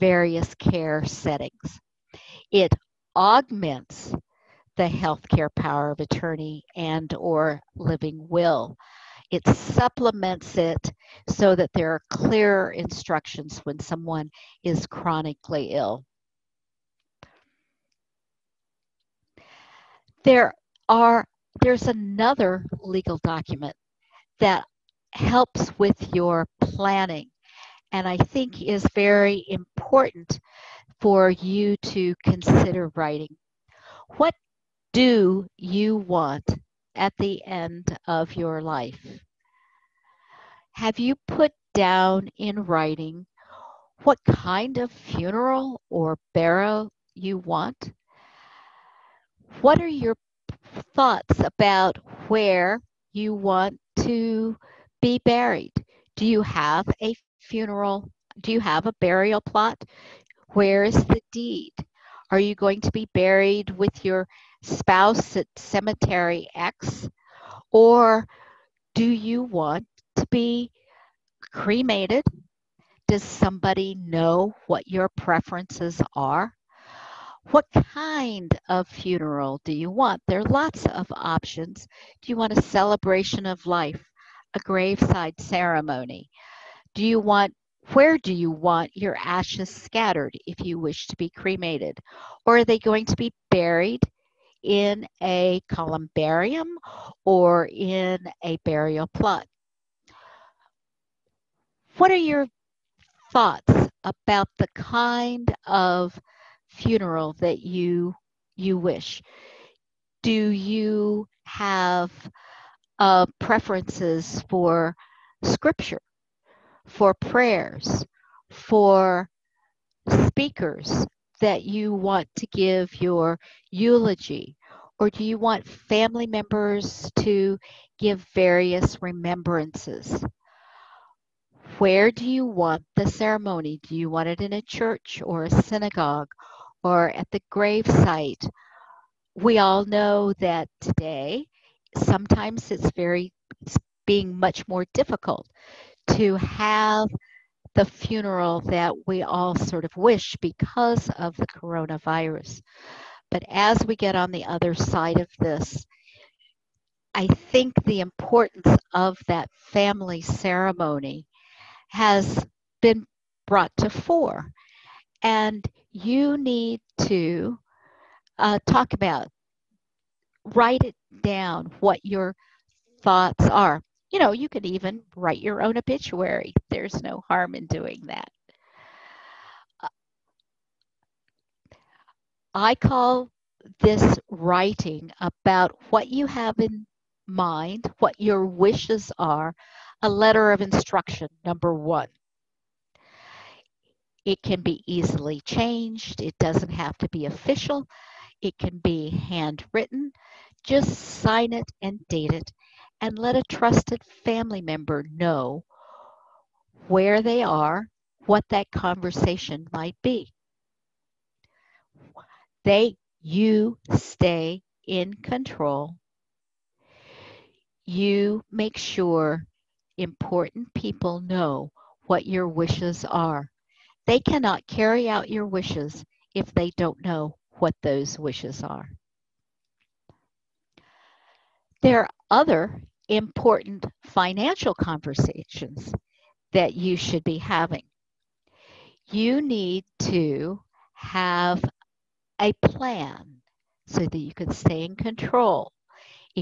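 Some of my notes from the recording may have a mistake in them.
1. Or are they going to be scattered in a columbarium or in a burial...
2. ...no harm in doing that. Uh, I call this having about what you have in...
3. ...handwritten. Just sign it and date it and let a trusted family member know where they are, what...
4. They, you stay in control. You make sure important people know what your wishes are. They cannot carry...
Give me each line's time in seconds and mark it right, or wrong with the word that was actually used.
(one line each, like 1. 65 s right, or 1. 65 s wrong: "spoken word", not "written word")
1. 92 s wrong: "buried", not "scattered"
2. 177 s wrong: "writing", not "having"
3. 199 s right
4. 212 s right.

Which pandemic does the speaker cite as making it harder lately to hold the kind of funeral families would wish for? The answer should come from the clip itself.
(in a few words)
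Coronavirus.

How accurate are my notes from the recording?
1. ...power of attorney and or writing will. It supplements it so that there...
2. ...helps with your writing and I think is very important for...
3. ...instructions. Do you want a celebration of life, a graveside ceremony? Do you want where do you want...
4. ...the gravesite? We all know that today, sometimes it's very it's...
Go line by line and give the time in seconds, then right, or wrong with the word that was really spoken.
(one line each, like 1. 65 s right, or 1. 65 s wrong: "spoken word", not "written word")
1. 5 s wrong: "living", not "writing"
2. 25 s wrong: "planning", not "writing"
3. 81 s wrong: "options", not "instructions"
4. 137 s right.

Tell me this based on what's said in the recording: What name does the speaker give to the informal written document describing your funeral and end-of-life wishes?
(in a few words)
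Letter of instruction.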